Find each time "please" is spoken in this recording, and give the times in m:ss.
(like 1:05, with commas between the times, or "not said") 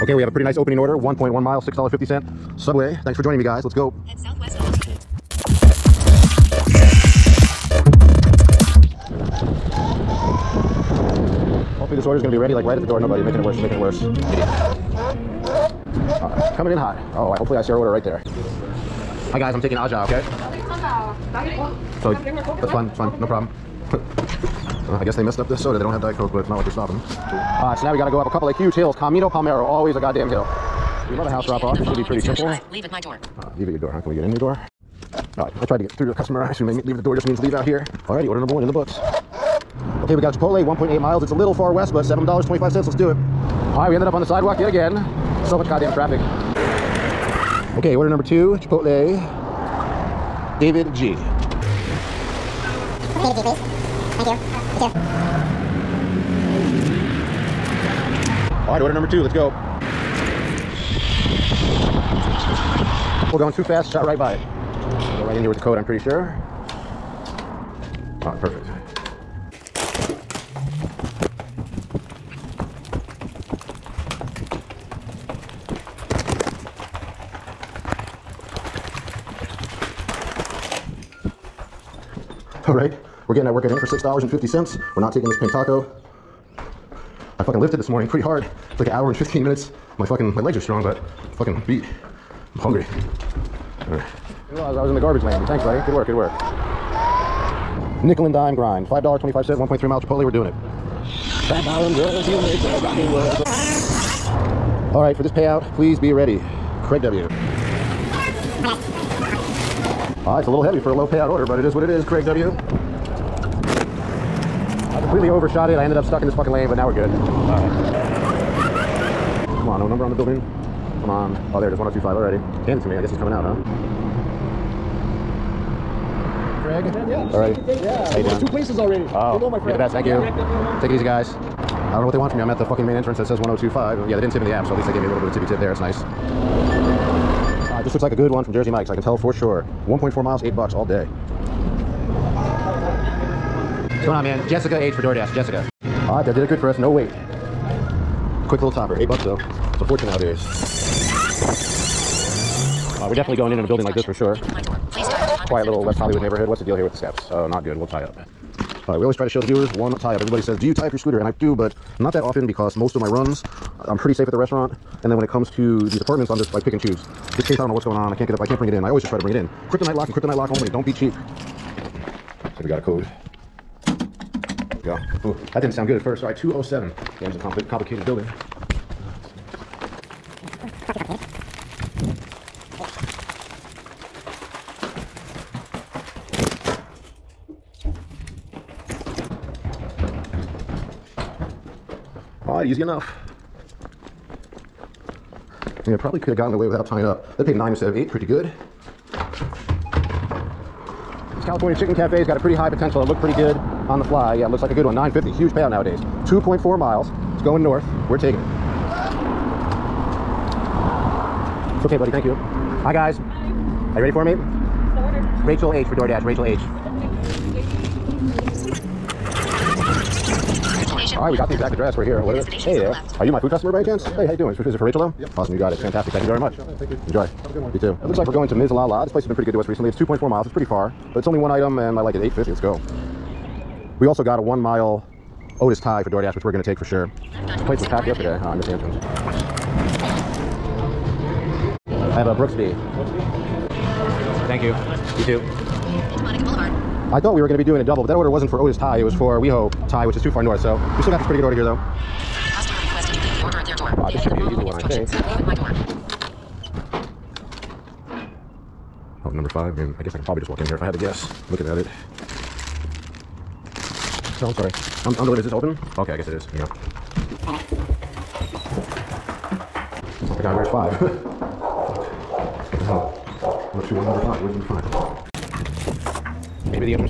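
0:53, 1:45.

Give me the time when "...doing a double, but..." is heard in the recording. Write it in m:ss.
4:07.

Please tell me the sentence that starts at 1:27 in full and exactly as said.
I fucking lifted this morning pretty hard.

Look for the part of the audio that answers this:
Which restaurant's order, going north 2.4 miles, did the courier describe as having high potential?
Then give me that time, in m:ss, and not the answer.
3:21.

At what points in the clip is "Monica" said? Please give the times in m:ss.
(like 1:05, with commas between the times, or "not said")
4:06.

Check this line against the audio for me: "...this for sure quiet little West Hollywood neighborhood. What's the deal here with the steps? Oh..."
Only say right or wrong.
right.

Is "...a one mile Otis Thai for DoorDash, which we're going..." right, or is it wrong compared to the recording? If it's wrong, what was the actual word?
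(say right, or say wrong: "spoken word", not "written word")
right.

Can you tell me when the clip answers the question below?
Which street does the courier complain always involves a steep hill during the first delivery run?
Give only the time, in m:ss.
0:28.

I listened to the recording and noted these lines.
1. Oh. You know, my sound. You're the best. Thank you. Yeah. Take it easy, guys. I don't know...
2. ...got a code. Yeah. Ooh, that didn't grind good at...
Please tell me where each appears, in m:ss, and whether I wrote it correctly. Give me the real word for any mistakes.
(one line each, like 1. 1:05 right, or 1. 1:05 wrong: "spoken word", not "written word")
1. 2:09 wrong: "friend", not "sound"
2. 2:52 wrong: "sound", not "grind".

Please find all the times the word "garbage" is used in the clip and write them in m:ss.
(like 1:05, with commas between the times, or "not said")
1:34.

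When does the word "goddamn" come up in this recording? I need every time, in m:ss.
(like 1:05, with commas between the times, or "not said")
0:29, 0:45.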